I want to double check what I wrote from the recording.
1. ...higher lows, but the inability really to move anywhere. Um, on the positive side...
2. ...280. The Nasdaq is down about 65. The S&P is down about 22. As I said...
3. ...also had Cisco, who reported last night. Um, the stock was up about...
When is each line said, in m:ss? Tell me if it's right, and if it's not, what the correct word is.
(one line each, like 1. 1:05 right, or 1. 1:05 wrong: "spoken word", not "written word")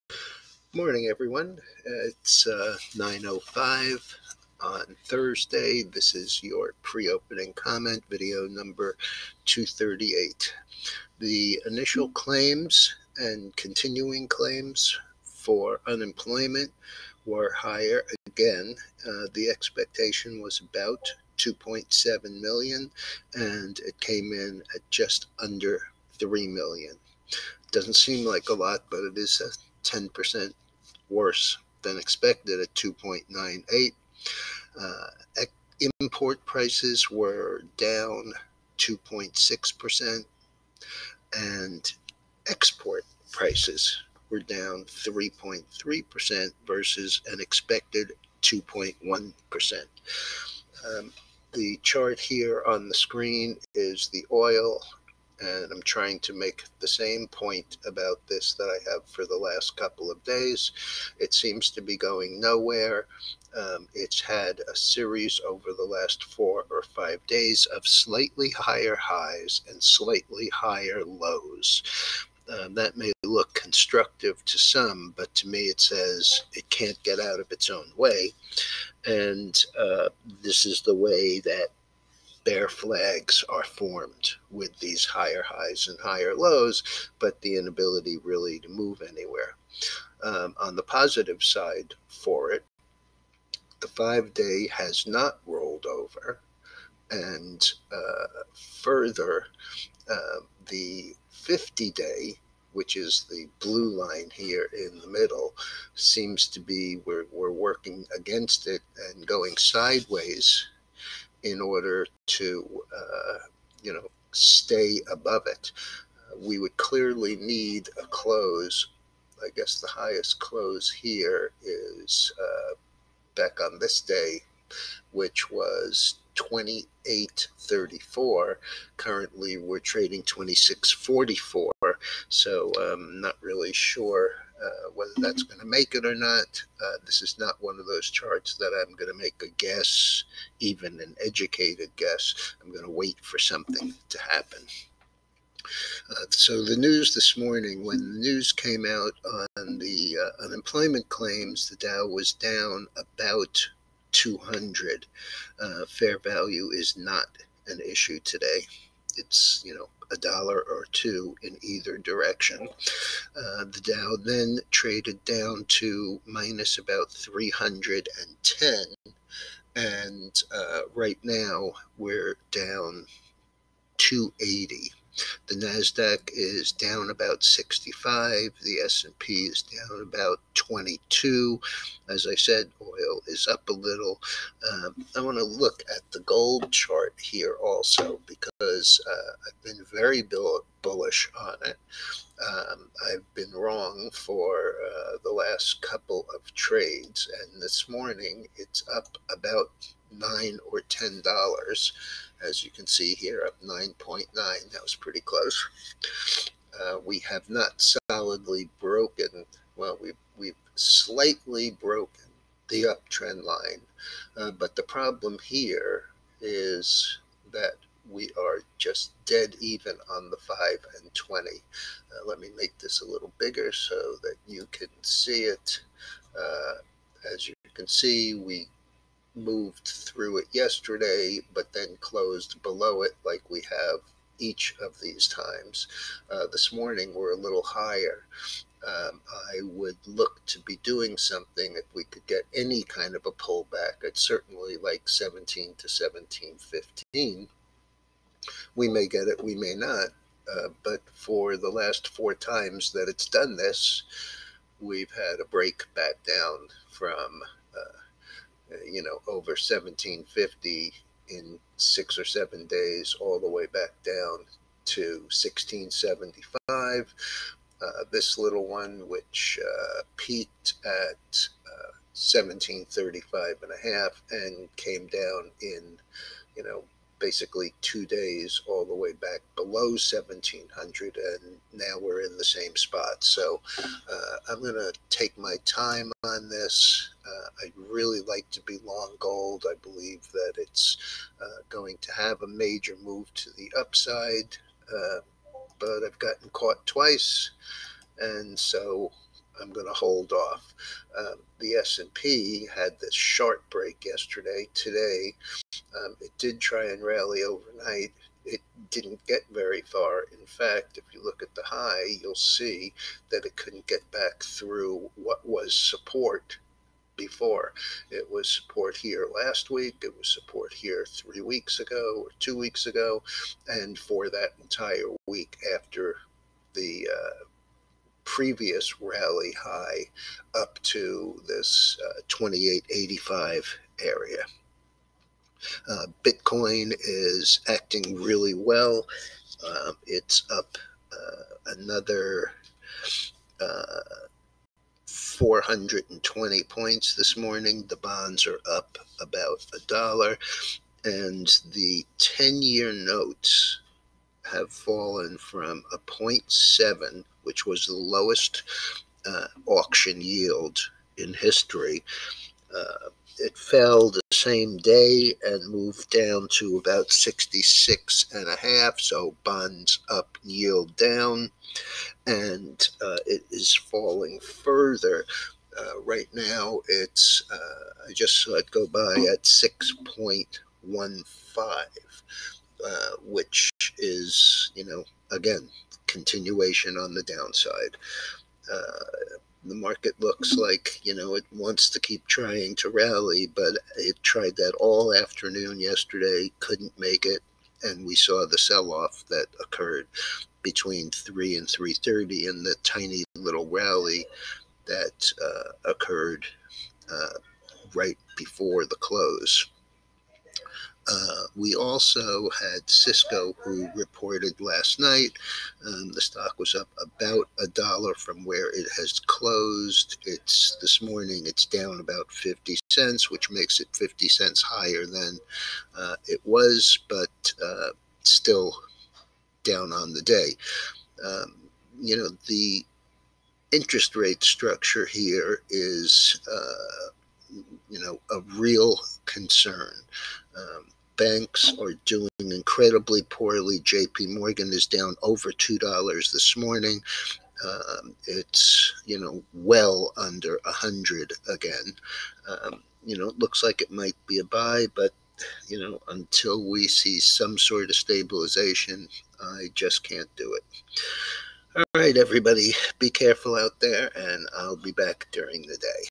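1. 1:25 right
2. 2:53 right
3. 6:51 right.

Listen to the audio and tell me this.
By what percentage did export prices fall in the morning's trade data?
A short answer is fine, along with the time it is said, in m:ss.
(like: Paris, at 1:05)
3.3%, at 0:44.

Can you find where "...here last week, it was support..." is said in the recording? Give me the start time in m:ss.
5:18.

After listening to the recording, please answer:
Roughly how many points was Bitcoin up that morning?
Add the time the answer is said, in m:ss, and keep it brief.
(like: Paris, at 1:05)
420, at 5:45.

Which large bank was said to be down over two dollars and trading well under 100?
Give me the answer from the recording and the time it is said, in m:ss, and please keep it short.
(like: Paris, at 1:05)
JP Morgan, at 7:23.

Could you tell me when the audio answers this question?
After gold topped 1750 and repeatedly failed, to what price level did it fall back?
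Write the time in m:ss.
4:25.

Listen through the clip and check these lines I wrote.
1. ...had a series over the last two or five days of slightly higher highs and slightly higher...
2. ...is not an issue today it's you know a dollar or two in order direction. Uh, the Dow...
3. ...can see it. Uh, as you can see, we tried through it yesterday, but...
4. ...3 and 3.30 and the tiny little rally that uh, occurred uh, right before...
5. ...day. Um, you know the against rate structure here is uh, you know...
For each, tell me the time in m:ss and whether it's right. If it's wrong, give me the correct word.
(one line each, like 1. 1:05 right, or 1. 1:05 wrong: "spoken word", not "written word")
1. 1:04 wrong: "four", not "two"
2. 2:36 wrong: "either", not "order"
3. 3:44 wrong: "moved", not "tried"
4. 6:41 right
5. 7:10 wrong: "interest", not "against".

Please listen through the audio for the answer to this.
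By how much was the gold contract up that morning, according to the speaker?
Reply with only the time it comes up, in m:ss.
3:23.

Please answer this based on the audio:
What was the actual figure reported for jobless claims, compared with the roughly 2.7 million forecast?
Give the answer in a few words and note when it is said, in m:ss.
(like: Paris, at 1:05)
2.98 million, at 0:32.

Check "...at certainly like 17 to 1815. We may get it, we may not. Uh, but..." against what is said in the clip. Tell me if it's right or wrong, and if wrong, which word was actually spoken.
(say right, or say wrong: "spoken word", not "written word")
wrong: "1715", not "1815".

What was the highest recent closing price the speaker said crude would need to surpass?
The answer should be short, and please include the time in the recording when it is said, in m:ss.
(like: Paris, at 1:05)
28.34, at 2:06.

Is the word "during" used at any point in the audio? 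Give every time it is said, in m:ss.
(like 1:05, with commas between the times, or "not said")
7:45.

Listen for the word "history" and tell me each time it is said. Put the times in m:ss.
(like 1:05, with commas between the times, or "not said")
6:01.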